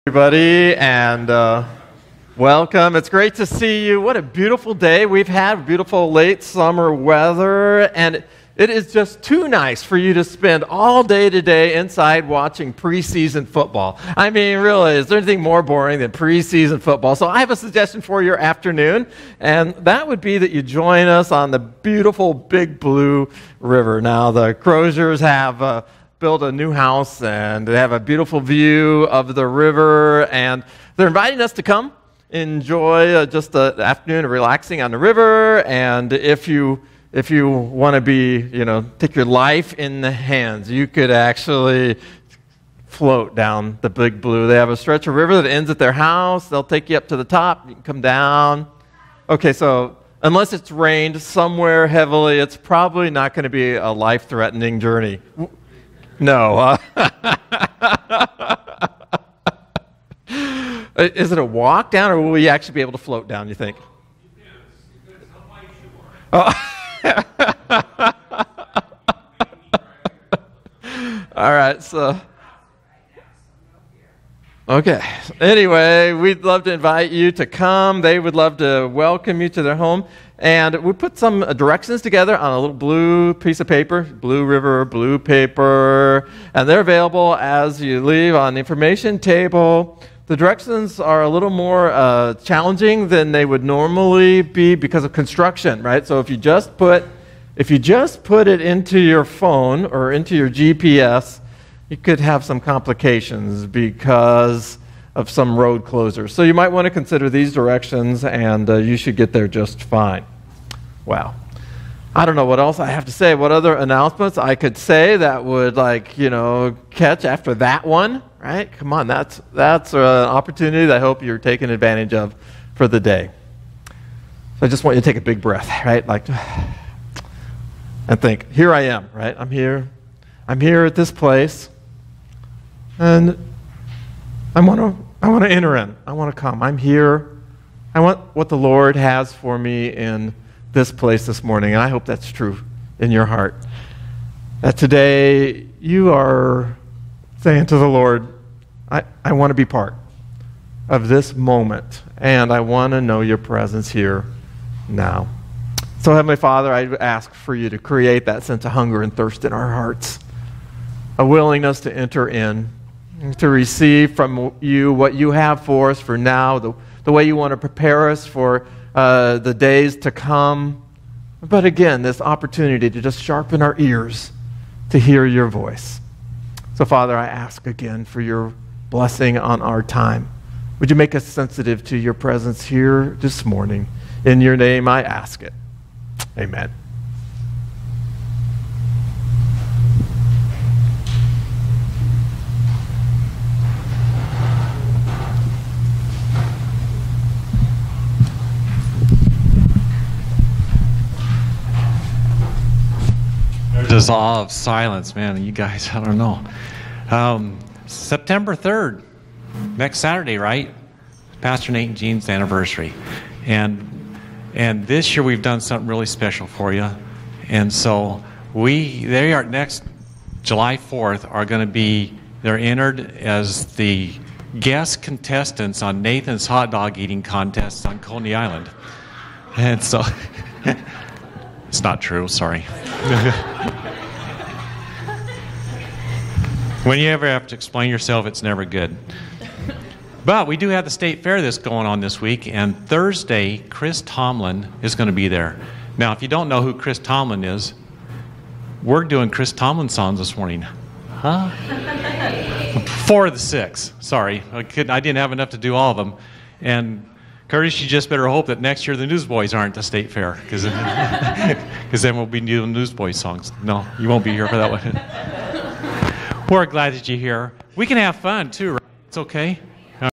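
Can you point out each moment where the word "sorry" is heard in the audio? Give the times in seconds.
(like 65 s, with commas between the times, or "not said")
232 s, 254 s.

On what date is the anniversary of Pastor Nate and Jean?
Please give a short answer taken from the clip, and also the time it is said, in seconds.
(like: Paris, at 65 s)
September 3rd, at 207 s.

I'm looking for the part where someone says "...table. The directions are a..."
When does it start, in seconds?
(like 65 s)
89 s.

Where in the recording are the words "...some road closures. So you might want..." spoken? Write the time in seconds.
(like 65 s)
105 s.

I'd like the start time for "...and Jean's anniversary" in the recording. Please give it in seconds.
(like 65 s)
211 s.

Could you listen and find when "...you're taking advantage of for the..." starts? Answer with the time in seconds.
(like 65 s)
121 s.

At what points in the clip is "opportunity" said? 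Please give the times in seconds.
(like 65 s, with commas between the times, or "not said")
119 s, 172 s.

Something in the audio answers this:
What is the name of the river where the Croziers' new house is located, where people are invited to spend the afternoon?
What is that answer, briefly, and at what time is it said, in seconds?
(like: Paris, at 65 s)
Big Blue River, at 22 s.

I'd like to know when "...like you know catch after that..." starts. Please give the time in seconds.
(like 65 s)
115 s.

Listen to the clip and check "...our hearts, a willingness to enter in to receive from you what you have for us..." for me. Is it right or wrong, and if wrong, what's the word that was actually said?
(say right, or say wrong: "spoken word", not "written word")
right.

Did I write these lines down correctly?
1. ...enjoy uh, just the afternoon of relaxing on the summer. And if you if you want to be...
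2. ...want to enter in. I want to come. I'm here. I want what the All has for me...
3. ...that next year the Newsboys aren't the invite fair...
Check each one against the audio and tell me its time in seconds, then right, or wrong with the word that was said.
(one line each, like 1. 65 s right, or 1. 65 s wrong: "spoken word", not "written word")
1. 32 s wrong: "river", not "summer"
2. 135 s wrong: "Lord", not "All"
3. 258 s wrong: "state", not "invite".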